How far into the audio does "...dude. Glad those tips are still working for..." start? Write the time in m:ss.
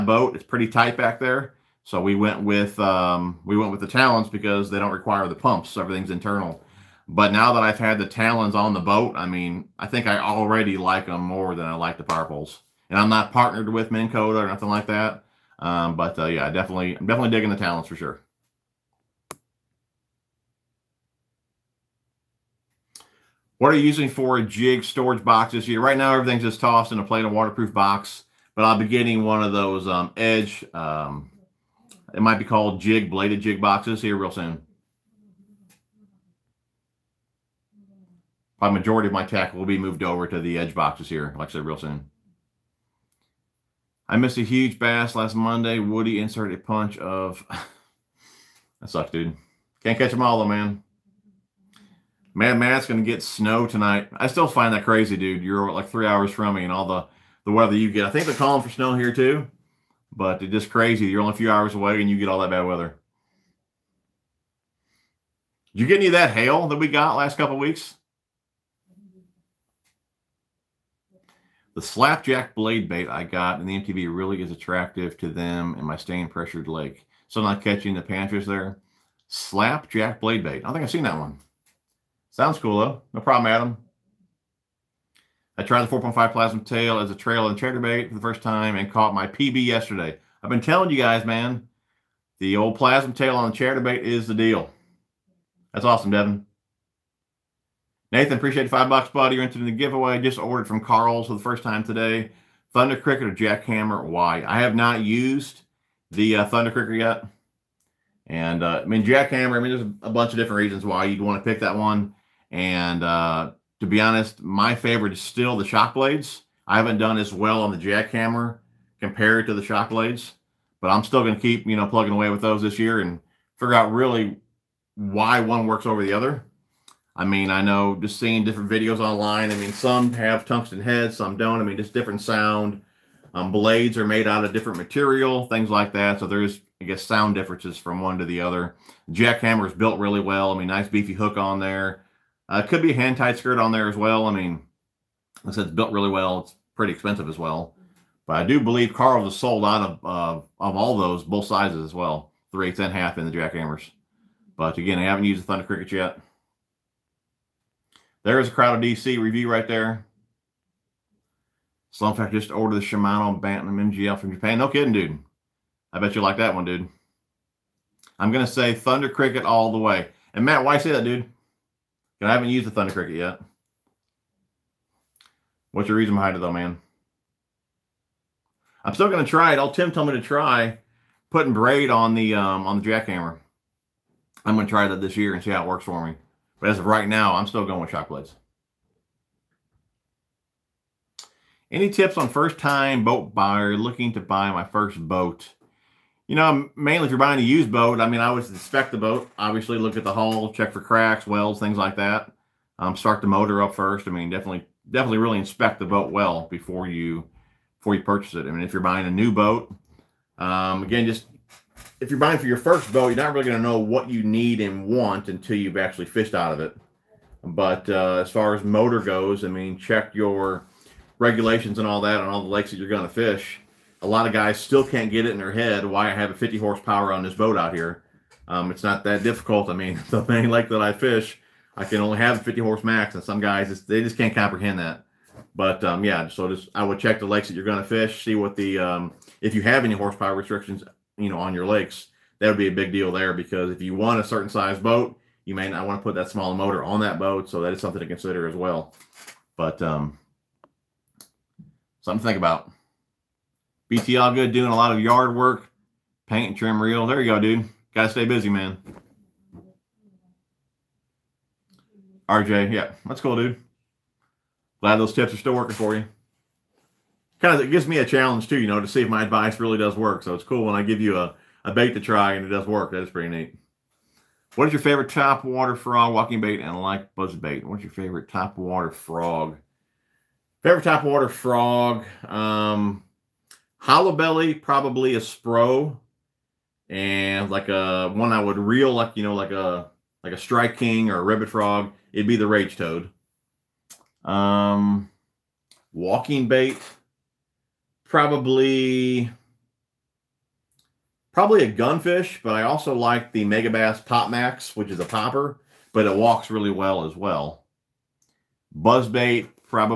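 4:23.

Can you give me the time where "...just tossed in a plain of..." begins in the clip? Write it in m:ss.
0:26.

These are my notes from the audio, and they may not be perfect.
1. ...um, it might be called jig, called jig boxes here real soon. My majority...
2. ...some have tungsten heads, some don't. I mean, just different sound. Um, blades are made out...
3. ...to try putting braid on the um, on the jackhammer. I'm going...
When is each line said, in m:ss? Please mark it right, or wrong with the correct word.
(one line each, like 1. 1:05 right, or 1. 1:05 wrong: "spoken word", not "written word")
1. 0:30 wrong: "bladed", not "called"
2. 2:09 right
3. 3:00 right.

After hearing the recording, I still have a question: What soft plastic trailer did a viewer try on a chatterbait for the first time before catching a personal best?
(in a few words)
4.5 plasma tail.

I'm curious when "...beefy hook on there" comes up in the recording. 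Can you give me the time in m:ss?
2:20.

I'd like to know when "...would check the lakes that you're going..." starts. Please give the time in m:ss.
3:56.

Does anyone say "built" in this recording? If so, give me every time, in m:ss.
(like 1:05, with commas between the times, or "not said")
2:19, 2:25.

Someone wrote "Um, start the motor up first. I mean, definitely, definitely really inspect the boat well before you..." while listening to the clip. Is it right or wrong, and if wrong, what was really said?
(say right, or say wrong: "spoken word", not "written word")
right.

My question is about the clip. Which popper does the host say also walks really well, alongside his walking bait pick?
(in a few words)
Mega Bass Pop Max.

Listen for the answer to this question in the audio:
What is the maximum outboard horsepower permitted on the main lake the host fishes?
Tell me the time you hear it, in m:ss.
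3:52.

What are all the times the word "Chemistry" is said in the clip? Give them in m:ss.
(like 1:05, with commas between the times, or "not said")
not said.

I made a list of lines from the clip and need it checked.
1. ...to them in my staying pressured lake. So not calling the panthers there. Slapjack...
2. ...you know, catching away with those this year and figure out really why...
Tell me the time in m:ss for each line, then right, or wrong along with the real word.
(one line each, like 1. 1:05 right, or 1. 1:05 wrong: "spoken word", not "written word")
1. 1:15 wrong: "catching", not "calling"
2. 2:01 wrong: "plugging", not "catching".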